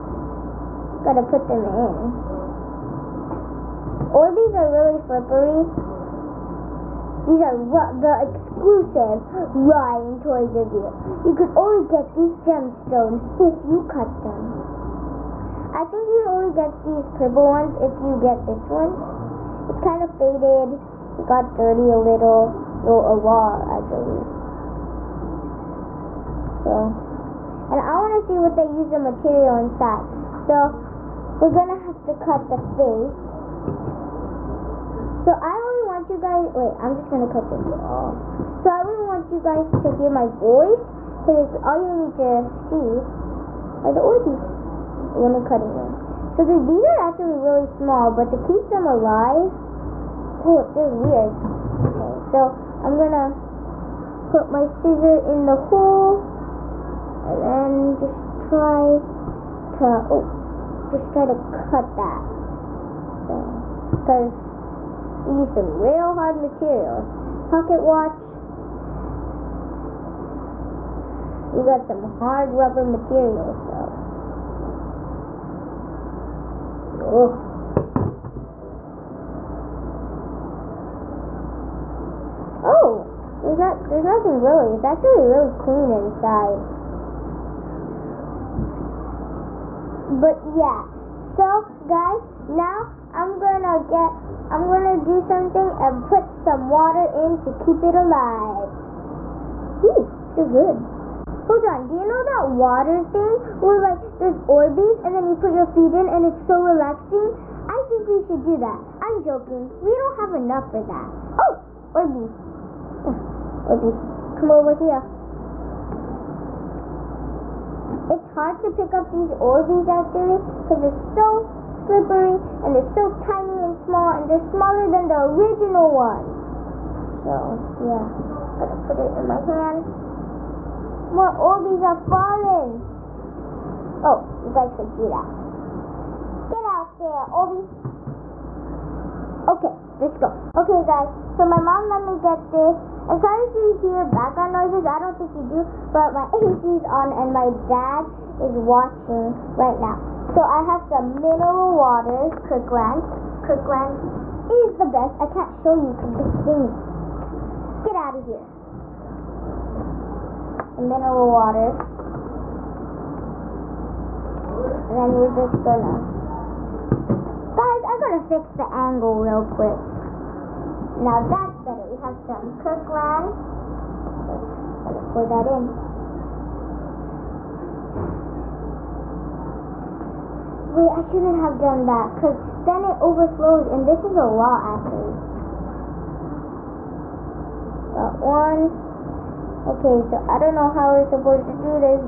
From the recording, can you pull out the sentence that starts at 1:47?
I think we should do that.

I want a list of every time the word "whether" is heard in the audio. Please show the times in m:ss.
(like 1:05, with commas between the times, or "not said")
not said.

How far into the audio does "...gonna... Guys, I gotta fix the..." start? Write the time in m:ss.
2:45.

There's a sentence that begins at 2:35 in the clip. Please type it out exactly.
I can't show you because this thing's...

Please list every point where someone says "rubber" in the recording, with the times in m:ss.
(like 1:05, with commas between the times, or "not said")
1:12.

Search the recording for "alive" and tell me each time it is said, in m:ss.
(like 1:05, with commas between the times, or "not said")
0:48, 1:37.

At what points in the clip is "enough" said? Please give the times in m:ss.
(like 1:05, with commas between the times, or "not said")
1:50.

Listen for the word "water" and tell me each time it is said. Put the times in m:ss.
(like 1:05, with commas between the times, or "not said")
1:36, 1:42, 2:31, 2:41.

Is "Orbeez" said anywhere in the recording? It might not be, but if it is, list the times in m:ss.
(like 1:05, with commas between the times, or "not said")
0:04, 0:44, 1:44, 1:59, 2:11.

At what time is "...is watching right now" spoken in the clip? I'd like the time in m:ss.
2:28.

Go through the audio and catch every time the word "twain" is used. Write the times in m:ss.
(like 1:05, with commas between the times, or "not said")
not said.